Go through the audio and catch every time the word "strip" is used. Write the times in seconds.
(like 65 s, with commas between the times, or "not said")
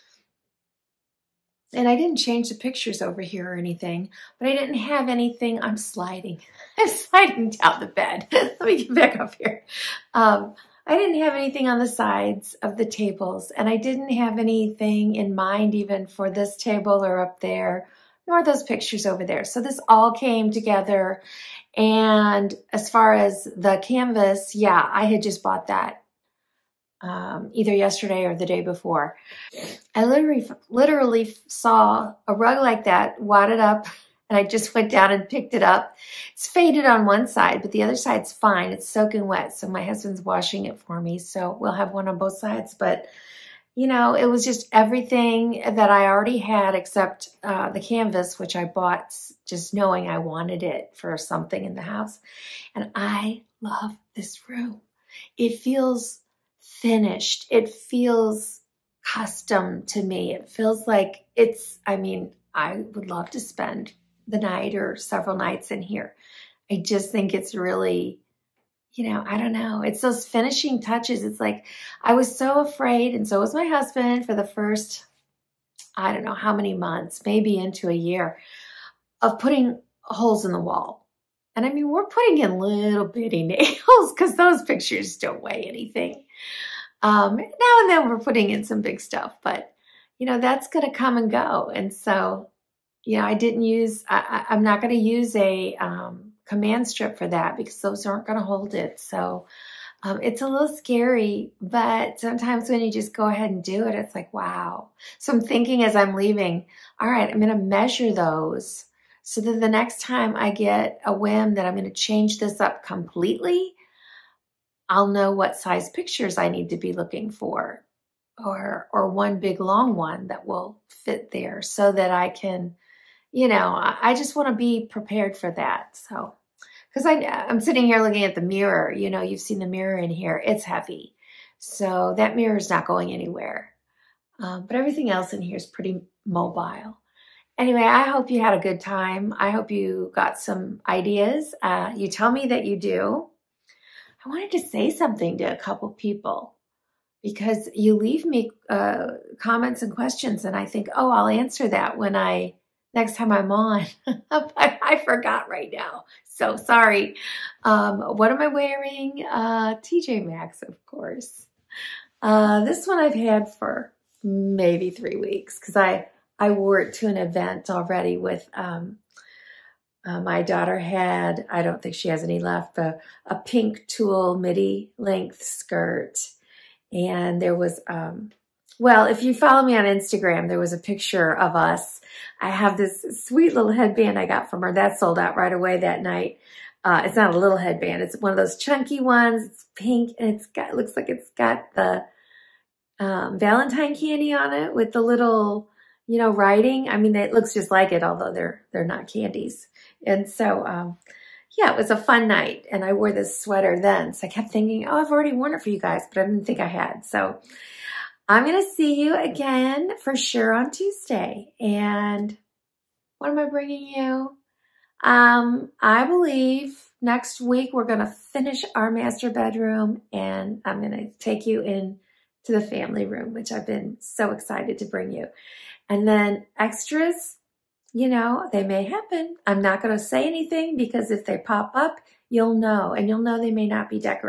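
96 s.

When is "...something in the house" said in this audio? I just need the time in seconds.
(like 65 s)
51 s.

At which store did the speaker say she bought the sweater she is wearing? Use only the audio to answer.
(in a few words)
TJ Maxx.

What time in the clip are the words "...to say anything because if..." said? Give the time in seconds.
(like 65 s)
229 s.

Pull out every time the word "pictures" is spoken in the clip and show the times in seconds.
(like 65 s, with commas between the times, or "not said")
2 s, 18 s, 84 s, 115 s, 180 s.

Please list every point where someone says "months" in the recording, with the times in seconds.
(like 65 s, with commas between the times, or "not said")
76 s.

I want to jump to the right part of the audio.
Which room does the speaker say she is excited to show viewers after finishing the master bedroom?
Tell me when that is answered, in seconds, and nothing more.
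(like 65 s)
222 s.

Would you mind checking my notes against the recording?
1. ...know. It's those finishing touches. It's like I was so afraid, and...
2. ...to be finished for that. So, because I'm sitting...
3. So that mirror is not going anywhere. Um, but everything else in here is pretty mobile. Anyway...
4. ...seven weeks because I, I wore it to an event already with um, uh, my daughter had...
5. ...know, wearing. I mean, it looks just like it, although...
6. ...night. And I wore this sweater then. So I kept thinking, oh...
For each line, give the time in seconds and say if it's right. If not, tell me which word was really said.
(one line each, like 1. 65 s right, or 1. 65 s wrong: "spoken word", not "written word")
1. 69 s right
2. 124 s wrong: "prepared", not "finished"
3. 131 s right
4. 164 s wrong: "three", not "seven"
5. 196 s wrong: "writing", not "wearing"
6. 202 s right.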